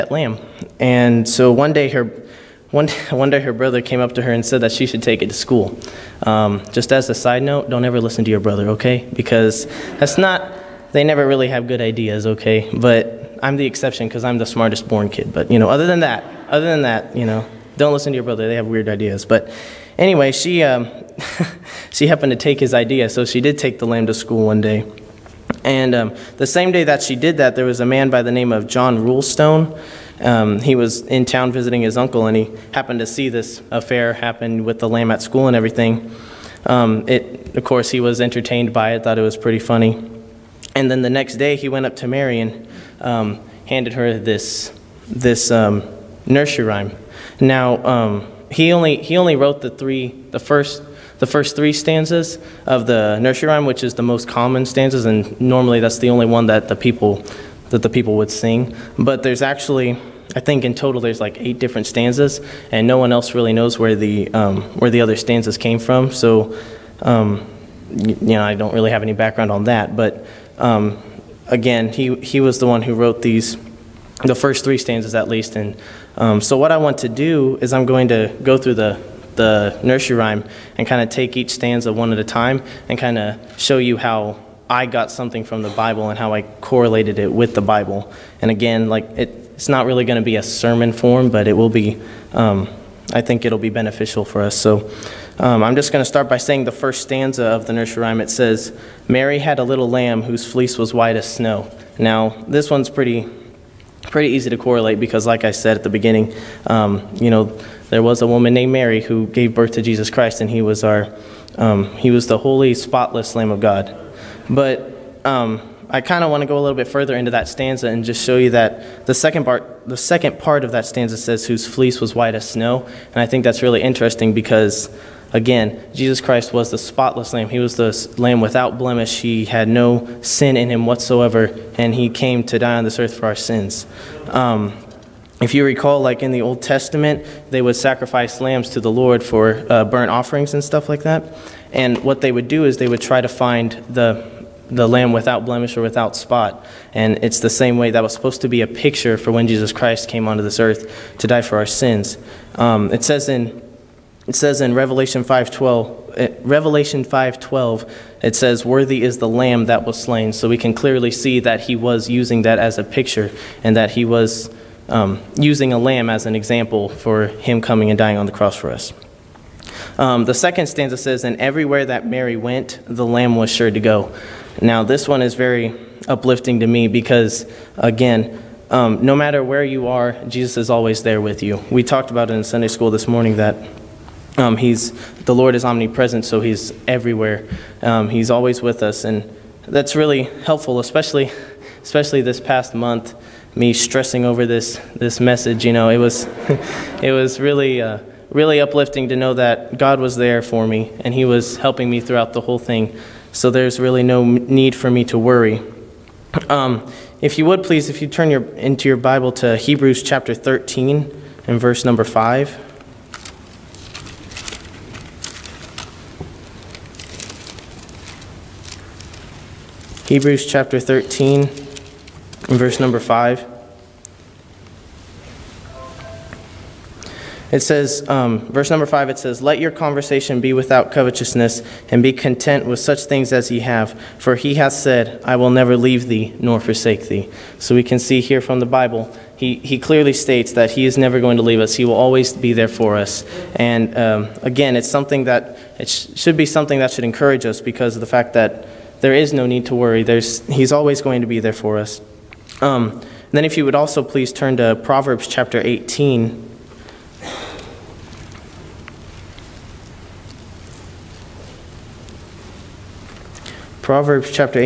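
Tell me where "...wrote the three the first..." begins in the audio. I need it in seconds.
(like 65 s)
49 s.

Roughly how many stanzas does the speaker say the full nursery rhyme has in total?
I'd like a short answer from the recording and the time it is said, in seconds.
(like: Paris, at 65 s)
8, at 61 s.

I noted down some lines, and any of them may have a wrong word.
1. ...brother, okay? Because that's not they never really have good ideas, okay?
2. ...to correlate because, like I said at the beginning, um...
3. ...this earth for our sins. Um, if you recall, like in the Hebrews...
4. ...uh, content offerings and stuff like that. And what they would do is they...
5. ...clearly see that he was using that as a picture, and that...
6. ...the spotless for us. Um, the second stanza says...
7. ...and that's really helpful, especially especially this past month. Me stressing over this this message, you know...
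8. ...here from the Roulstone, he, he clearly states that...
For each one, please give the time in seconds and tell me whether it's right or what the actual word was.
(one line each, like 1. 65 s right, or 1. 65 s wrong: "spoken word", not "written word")
1. 8 s right
2. 104 s right
3. 132 s wrong: "Old", not "Hebrews"
4. 139 s wrong: "burnt", not "content"
5. 160 s right
6. 168 s wrong: "cross", not "spotless"
7. 189 s right
8. 238 s wrong: "Bible", not "Roulstone".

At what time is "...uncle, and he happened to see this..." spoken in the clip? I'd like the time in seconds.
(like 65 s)
31 s.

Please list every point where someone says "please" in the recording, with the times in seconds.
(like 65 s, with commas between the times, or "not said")
207 s, 254 s.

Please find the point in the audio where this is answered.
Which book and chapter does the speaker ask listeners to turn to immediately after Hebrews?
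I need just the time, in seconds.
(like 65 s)
254 s.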